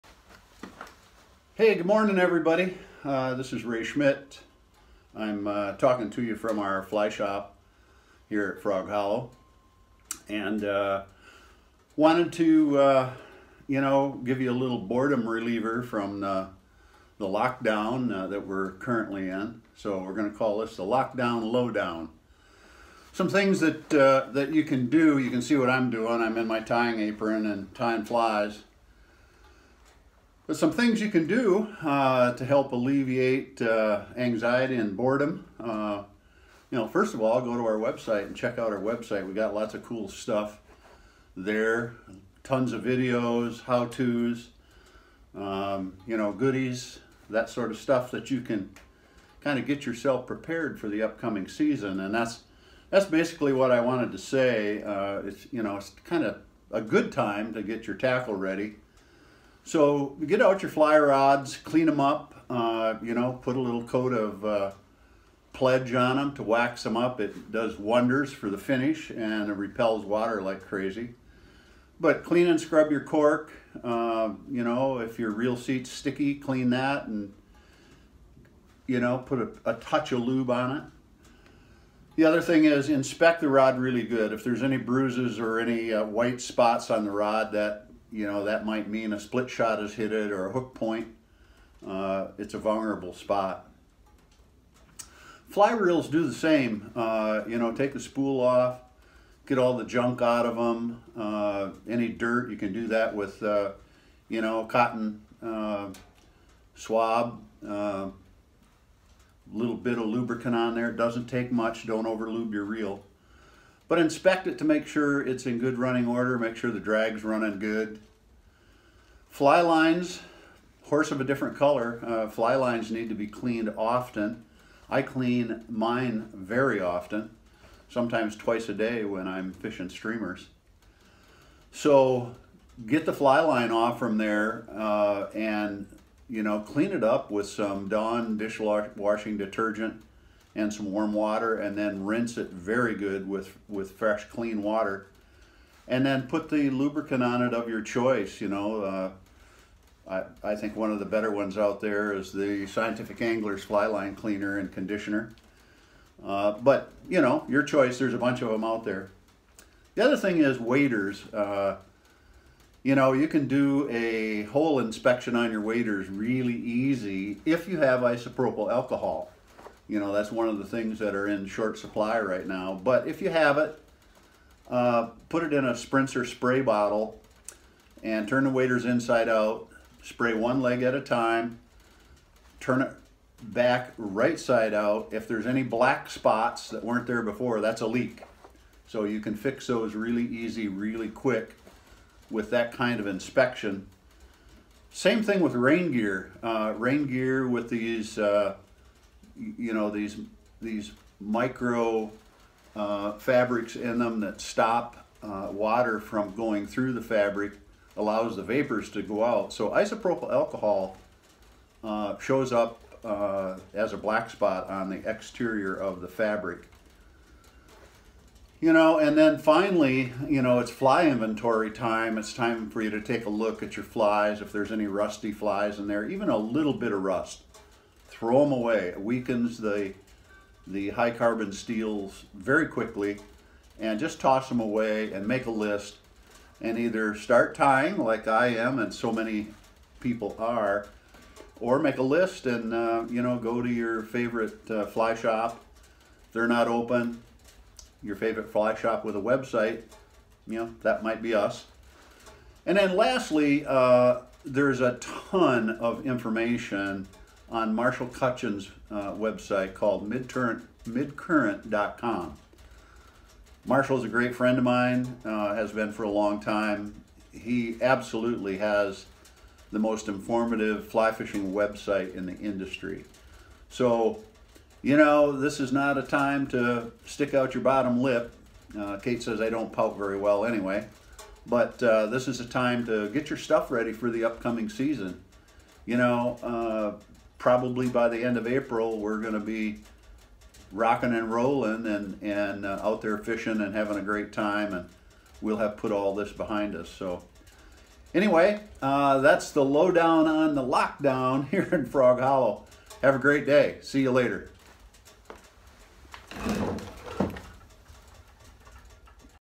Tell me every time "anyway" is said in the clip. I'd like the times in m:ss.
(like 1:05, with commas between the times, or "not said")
4:40, 4:58.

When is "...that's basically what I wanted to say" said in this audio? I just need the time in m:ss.
0:52.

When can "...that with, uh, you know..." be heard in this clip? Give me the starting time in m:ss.
1:42.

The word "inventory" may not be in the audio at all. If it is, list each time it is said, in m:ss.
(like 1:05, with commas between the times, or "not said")
3:41.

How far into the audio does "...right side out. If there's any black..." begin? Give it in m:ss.
3:03.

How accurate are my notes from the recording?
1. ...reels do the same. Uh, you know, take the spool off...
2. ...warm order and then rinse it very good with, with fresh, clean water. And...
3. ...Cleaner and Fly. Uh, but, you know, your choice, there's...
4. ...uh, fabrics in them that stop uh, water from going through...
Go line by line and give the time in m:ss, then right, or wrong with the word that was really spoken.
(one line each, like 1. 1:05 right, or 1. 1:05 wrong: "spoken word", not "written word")
1. 1:35 right
2. 2:20 wrong: "water", not "order"
3. 2:34 wrong: "Conditioner", not "Fly"
4. 3:22 right.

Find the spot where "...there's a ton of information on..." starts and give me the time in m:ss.
4:14.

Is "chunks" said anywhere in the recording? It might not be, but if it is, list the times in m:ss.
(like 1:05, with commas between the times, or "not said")
not said.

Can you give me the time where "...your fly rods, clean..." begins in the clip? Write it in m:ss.
1:00.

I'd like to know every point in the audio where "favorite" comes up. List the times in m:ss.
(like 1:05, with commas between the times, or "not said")
4:04, 4:08.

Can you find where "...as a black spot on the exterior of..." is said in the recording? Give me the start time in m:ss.
3:33.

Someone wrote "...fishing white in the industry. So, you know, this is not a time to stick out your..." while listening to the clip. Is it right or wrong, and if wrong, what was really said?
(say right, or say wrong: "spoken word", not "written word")
wrong: "website", not "white".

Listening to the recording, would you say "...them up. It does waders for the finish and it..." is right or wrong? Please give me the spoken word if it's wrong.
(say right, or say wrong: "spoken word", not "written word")
wrong: "wonders", not "waders".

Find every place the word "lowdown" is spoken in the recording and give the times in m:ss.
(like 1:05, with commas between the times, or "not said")
0:21, 4:59.